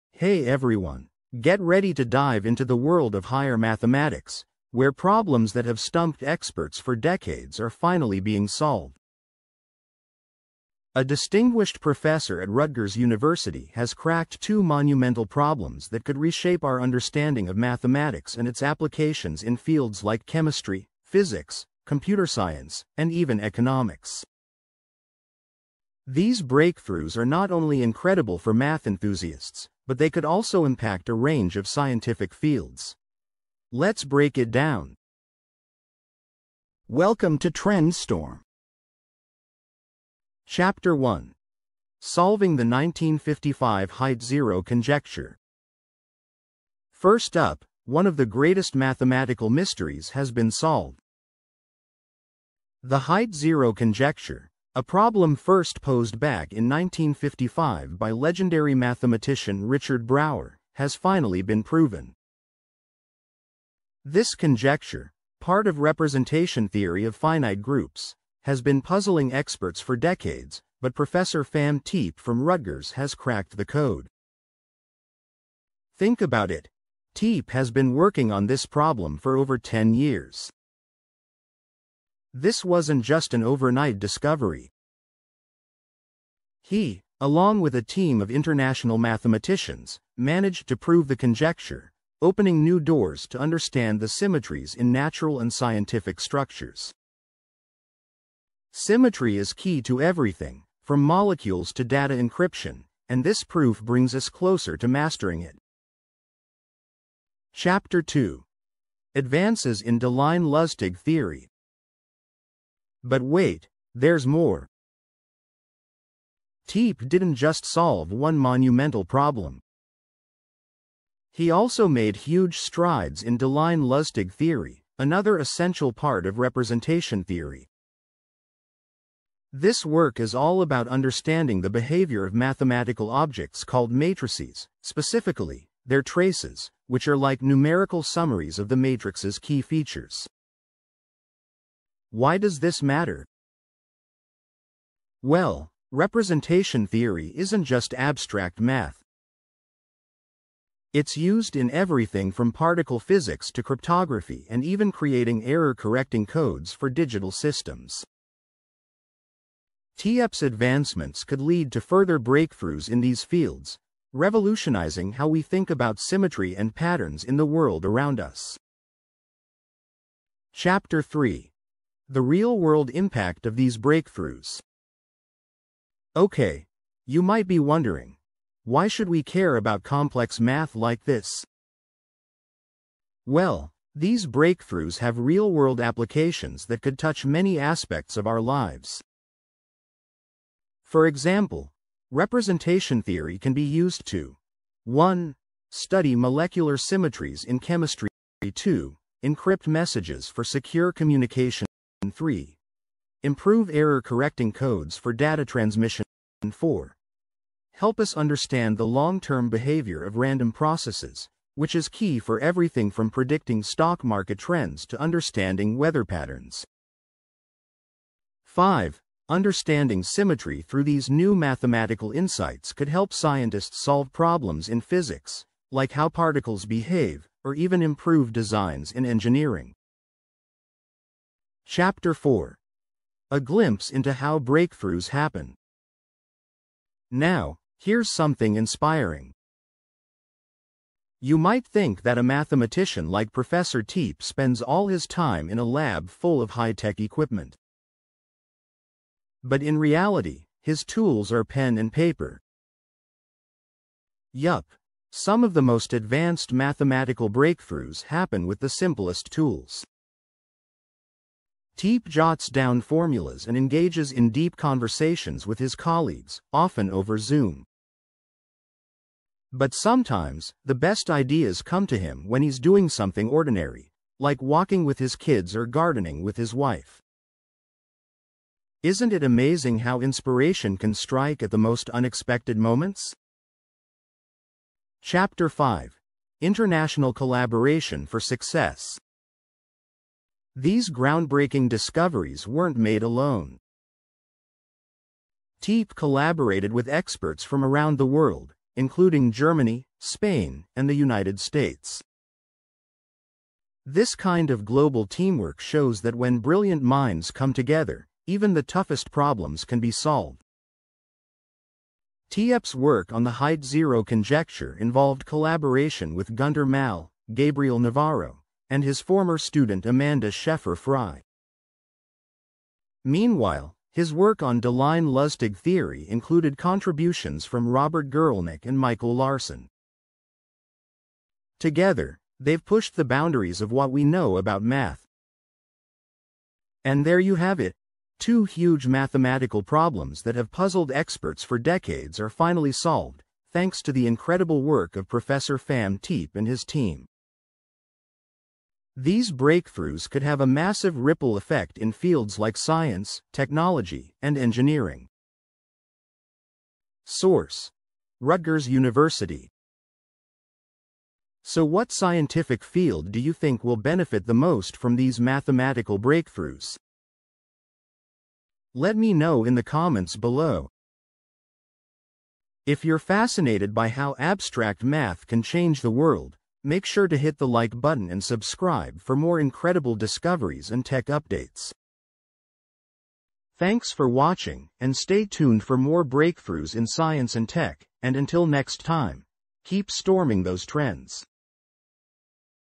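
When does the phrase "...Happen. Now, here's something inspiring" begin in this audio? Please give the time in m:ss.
3:55.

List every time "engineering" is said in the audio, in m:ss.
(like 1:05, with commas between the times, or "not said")
3:49, 5:54.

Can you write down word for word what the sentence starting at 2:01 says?
He also made huge strides in Deligne-Lusztig theory, another essential part of representation theory.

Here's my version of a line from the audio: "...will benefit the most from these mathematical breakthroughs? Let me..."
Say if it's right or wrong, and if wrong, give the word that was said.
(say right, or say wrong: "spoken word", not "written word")
right.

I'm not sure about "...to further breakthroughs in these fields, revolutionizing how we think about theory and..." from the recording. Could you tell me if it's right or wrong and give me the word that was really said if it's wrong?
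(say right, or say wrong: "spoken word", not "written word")
wrong: "symmetry", not "theory".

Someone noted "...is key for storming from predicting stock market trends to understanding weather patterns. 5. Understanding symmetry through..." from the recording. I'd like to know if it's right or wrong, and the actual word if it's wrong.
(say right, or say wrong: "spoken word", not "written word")
wrong: "everything", not "storming".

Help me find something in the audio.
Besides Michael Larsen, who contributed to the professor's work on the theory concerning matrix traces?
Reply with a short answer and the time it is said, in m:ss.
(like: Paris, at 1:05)
Robert Guralnick, at 5:27.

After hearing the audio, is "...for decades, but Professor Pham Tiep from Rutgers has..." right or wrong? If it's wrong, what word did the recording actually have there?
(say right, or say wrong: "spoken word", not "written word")
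right.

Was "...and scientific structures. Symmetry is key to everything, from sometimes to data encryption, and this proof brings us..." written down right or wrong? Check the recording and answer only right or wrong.
wrong.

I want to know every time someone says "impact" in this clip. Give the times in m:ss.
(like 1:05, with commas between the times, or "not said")
0:30, 2:52.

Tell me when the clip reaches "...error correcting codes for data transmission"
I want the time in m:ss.
3:23.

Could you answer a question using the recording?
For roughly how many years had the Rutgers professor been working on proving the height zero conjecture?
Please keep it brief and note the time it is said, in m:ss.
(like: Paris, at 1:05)
over 10 years, at 1:19.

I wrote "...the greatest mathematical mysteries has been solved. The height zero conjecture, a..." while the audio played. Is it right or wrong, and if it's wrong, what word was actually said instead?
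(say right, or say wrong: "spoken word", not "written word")
right.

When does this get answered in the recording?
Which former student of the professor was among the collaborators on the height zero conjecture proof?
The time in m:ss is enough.
5:19.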